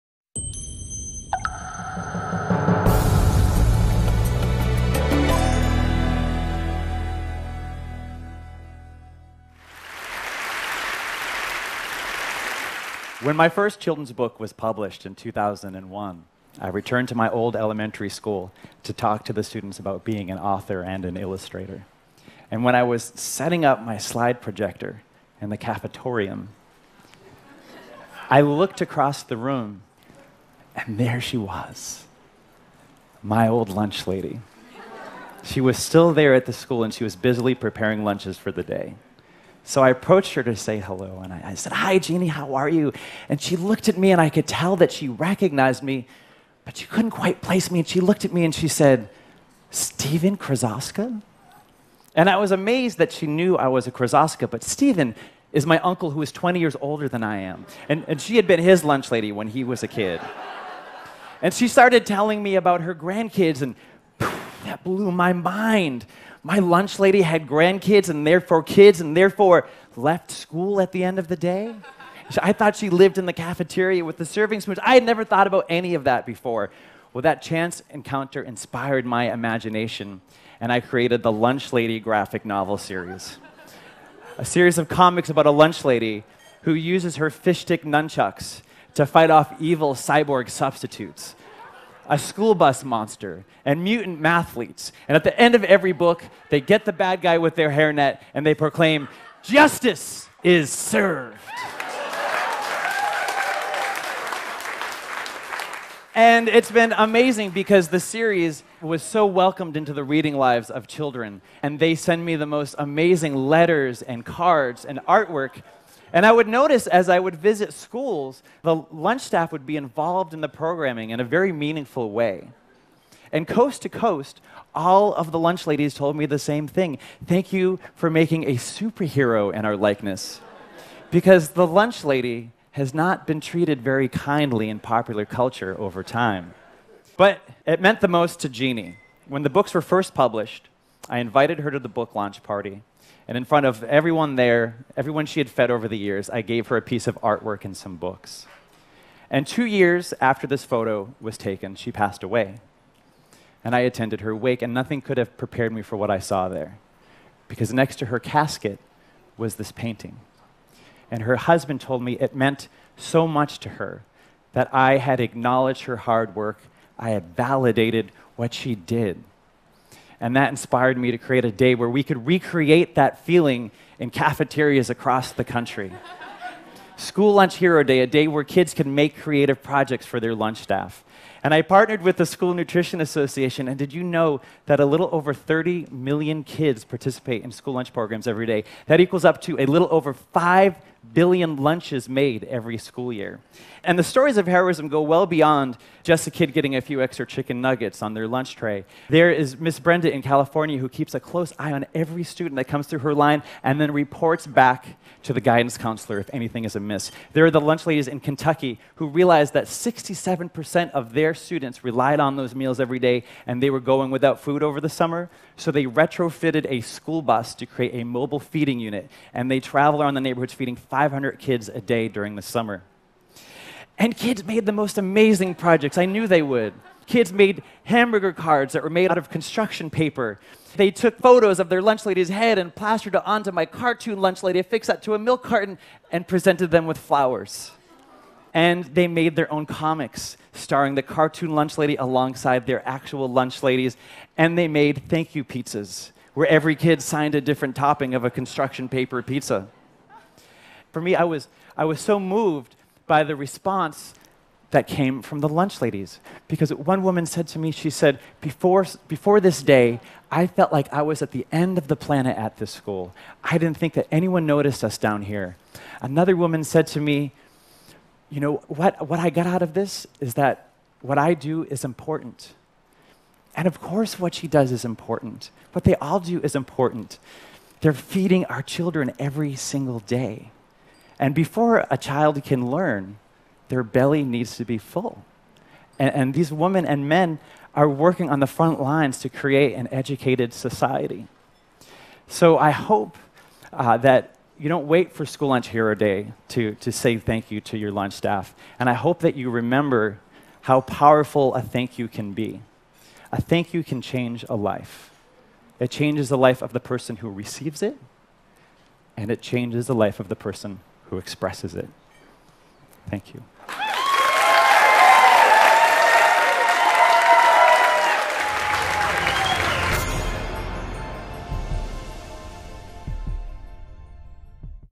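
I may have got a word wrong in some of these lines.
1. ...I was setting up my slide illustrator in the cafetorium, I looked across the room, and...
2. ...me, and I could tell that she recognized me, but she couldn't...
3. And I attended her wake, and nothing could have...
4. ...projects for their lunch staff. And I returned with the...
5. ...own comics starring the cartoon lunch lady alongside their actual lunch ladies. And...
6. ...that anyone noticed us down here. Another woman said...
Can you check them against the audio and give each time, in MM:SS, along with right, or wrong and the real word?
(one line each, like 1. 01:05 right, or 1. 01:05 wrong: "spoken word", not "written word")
1. 00:22 wrong: "projector", not "illustrator"
2. 00:43 right
3. 02:33 right
4. 02:59 wrong: "partnered", not "returned"
5. 03:59 right
6. 04:23 right.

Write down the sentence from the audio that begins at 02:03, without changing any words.
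And coast to coast, all of the lunch ladies told me the same thing.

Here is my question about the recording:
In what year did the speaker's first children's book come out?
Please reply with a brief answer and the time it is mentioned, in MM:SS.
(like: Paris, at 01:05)
2001, at 00:15.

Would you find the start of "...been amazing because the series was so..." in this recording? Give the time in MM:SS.
01:46.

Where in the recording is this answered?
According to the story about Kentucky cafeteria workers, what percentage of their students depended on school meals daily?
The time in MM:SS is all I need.
03:29.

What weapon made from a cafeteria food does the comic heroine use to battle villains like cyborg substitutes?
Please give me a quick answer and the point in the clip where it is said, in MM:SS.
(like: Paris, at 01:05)
fishstick nunchucks, at 01:27.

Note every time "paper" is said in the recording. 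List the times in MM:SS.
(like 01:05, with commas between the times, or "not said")
03:49, 04:08.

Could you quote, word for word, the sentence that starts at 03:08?
That equals up to a little over 5 billion lunches made every school year.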